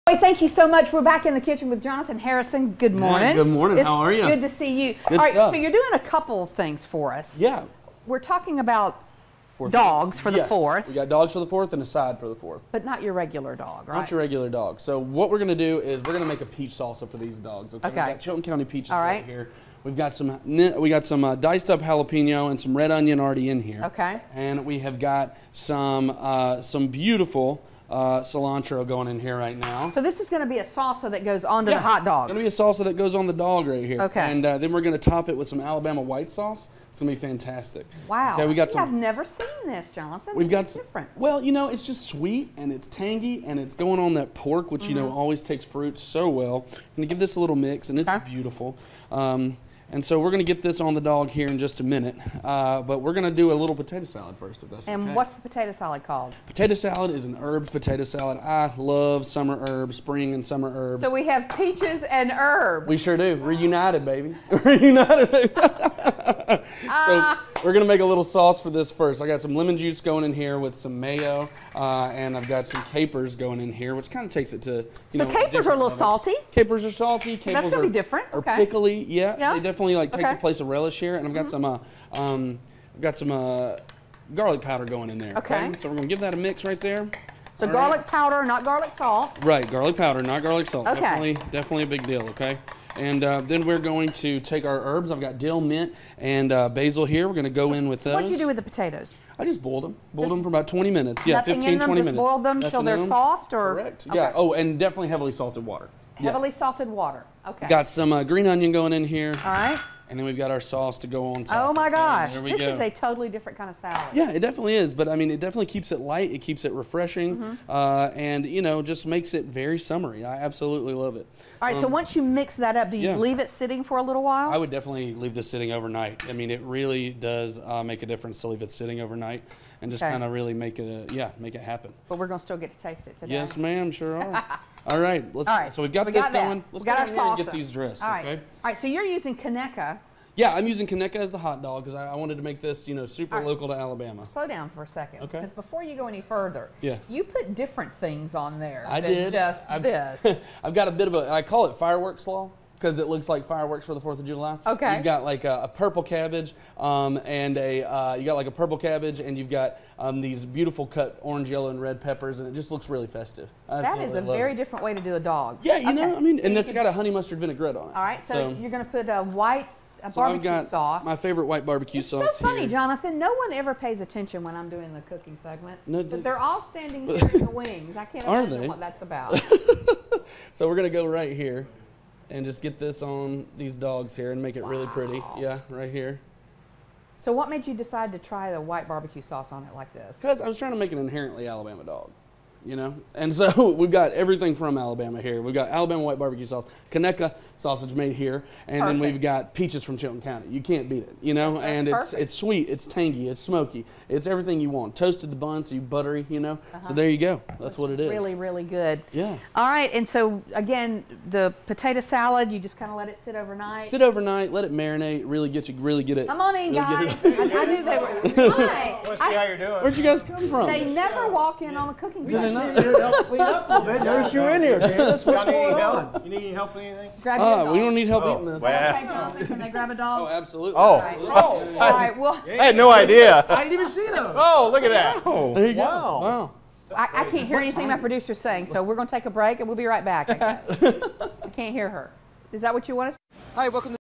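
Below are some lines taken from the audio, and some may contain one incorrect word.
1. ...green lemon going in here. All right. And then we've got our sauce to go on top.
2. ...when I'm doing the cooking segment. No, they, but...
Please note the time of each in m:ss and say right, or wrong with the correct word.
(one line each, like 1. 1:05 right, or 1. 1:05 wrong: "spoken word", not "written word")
1. 1:48 wrong: "onion", not "lemon"
2. 2:54 right.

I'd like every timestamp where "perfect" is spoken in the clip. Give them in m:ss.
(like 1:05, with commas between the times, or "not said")
3:18.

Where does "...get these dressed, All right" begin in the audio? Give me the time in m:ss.
2:17.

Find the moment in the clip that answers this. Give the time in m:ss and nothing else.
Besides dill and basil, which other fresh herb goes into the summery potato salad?
1:35.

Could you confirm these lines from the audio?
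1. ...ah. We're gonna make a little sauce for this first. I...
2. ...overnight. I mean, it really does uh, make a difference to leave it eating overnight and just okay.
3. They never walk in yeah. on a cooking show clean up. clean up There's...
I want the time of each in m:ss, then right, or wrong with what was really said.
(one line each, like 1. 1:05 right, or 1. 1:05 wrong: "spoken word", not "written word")
1. 1:05 right
2. 2:05 wrong: "sitting", not "eating"
3. 3:40 right.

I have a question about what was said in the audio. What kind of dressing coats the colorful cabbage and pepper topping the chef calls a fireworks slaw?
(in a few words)
honey mustard vinaigrette.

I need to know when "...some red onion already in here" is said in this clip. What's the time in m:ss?
0:22.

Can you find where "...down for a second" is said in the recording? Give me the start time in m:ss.
2:24.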